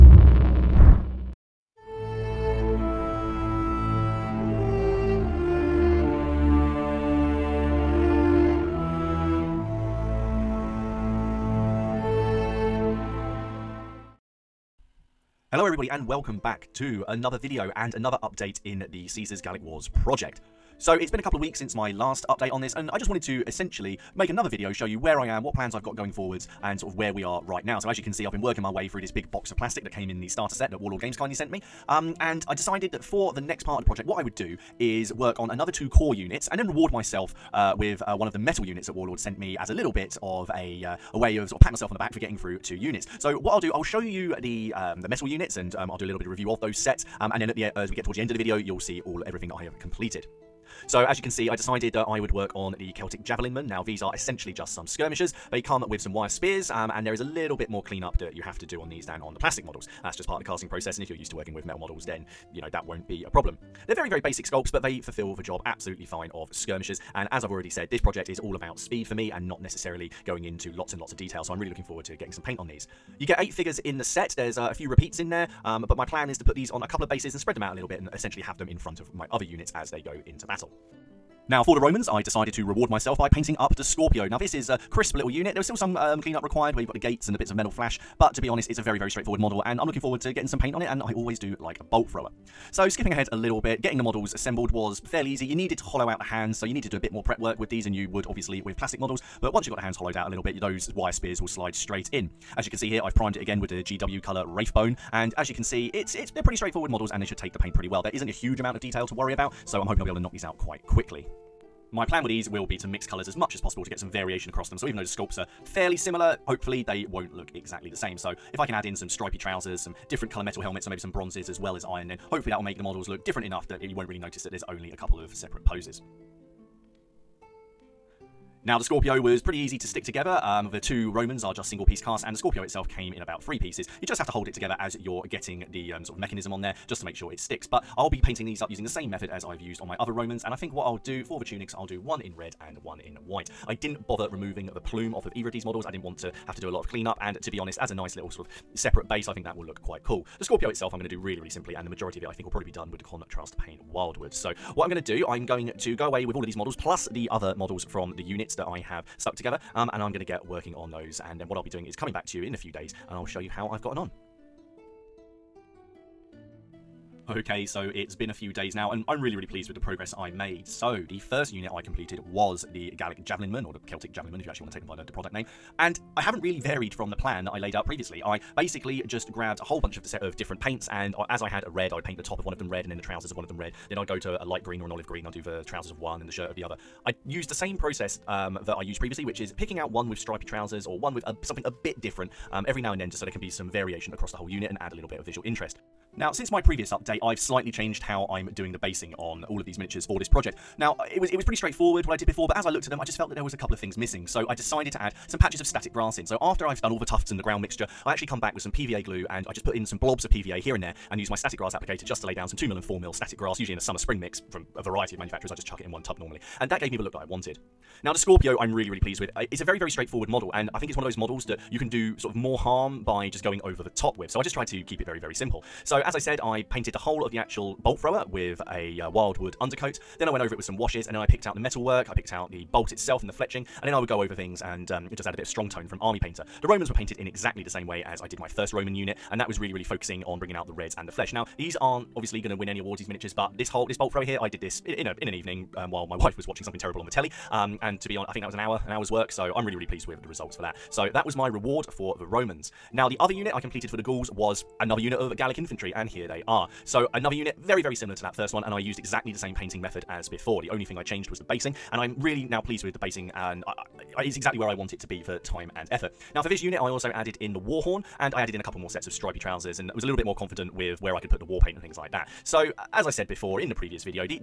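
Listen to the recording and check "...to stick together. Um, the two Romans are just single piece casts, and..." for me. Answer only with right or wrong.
right.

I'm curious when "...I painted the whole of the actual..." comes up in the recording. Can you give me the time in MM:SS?
03:46.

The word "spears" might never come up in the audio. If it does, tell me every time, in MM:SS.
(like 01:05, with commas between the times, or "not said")
00:56, 01:41.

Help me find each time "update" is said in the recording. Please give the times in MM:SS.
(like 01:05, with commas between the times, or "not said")
00:18, 00:22, 03:16.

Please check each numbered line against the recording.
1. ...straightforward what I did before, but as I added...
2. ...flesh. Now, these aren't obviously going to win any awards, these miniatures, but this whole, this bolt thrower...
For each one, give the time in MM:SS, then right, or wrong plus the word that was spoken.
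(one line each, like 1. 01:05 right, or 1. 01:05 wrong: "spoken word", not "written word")
1. 03:21 wrong: "looked", not "added"
2. 04:01 right.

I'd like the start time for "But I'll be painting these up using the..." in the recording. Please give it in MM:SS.
02:17.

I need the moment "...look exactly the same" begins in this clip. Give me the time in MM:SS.
01:57.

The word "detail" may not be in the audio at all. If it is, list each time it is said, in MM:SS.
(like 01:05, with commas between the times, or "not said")
01:11, 01:48.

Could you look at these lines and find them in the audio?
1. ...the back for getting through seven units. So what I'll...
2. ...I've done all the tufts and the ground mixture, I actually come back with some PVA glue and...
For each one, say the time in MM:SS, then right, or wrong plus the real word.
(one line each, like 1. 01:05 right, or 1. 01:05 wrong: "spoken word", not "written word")
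1. 00:41 wrong: "two", not "seven"
2. 03:26 right.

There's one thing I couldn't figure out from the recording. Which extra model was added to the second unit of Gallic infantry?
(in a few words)
war horn.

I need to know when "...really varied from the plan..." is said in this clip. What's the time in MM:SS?
02:56.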